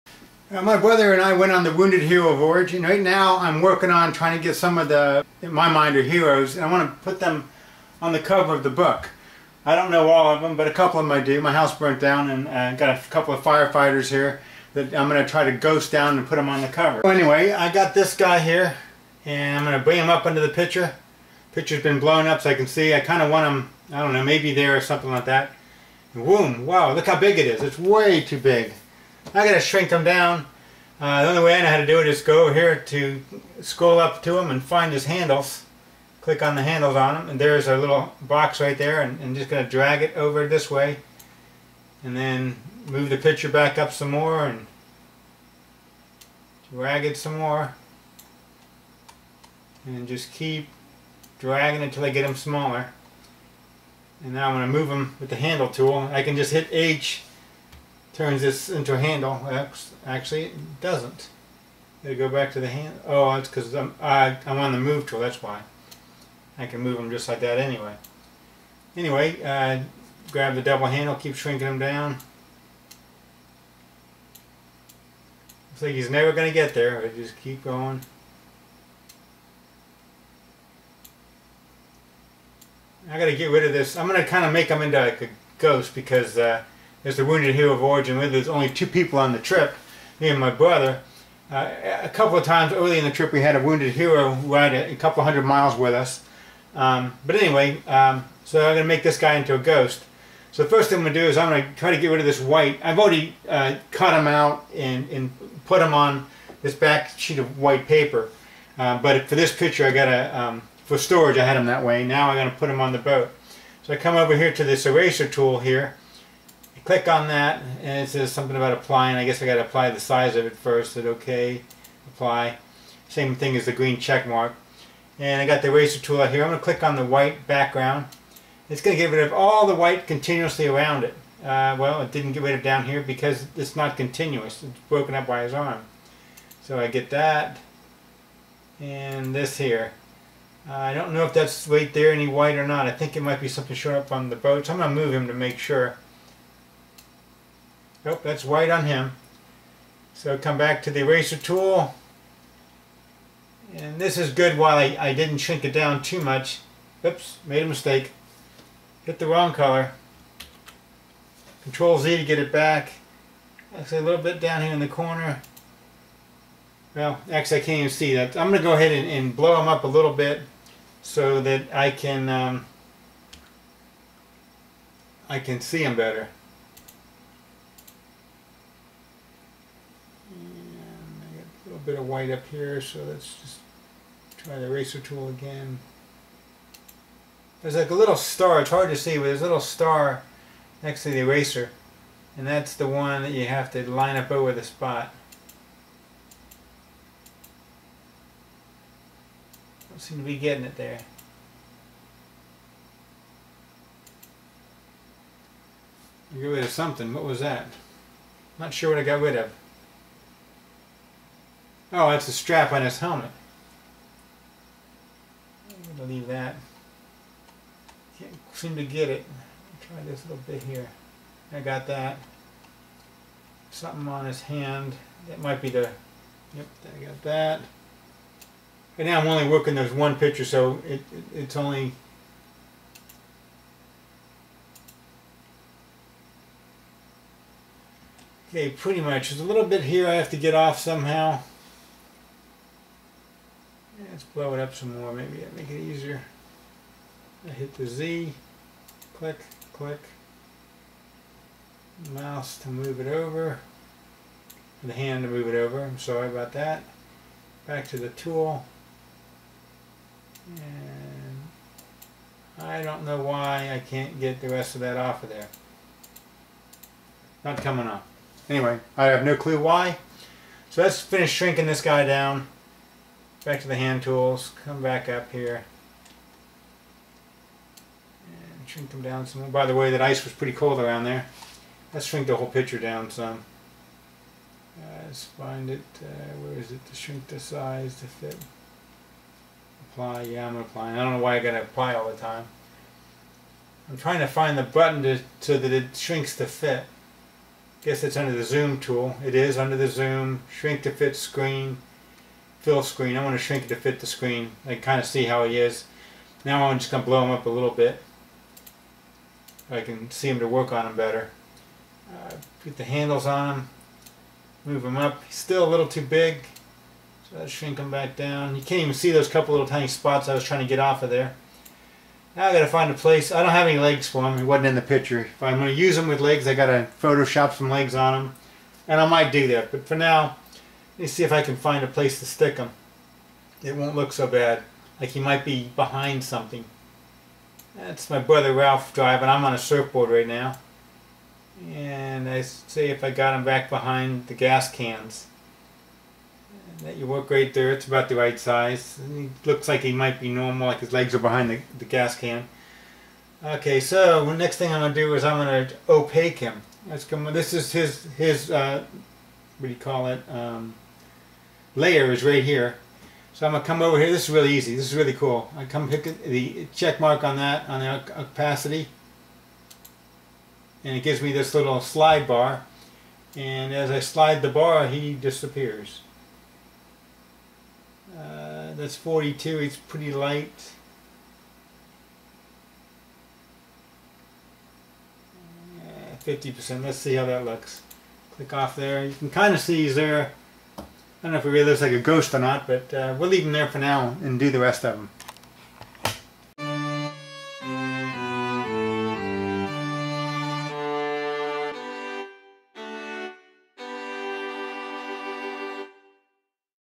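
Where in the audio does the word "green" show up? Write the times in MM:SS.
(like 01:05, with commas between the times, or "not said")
02:03.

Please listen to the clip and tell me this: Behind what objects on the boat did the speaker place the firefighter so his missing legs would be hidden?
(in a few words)
gas cans.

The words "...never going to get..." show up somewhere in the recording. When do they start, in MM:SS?
01:16.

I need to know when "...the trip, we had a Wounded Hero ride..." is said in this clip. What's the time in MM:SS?
01:33.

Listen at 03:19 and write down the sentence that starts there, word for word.
Don't seem to be getting it there.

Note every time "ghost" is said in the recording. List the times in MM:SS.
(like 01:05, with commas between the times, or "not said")
00:15, 01:25, 01:39, 06:31.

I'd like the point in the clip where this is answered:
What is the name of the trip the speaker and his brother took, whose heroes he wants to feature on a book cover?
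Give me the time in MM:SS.
00:01.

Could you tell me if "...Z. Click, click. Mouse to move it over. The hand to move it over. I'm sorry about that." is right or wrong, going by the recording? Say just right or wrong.
right.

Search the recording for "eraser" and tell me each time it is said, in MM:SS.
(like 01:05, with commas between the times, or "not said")
01:54, 02:05, 02:31, 03:04, 03:11.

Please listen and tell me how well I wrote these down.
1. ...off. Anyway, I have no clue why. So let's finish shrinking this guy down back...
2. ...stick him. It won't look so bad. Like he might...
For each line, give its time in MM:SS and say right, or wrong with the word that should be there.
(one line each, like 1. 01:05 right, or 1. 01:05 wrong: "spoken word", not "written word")
1. 04:27 right
2. 05:32 right.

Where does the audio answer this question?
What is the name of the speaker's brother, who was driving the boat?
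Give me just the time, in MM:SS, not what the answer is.
05:38.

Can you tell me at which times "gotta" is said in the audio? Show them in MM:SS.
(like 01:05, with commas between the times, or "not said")
00:29, 04:51.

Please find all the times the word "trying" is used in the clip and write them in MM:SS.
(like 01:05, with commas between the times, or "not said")
00:04, 04:53, 05:20.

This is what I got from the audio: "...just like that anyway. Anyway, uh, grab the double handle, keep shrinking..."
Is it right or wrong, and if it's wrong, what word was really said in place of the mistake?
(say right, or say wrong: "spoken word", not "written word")
right.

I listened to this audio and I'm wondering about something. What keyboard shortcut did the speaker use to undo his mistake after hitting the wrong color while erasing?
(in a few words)
Control Z.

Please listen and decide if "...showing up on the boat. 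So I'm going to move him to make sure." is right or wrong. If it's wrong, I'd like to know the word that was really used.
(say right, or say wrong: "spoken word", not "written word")
right.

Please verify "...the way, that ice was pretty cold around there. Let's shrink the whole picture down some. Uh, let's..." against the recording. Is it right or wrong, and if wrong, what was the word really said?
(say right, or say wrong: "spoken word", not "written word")
right.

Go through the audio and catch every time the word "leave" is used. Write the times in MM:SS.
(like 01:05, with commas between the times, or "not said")
03:36, 06:33.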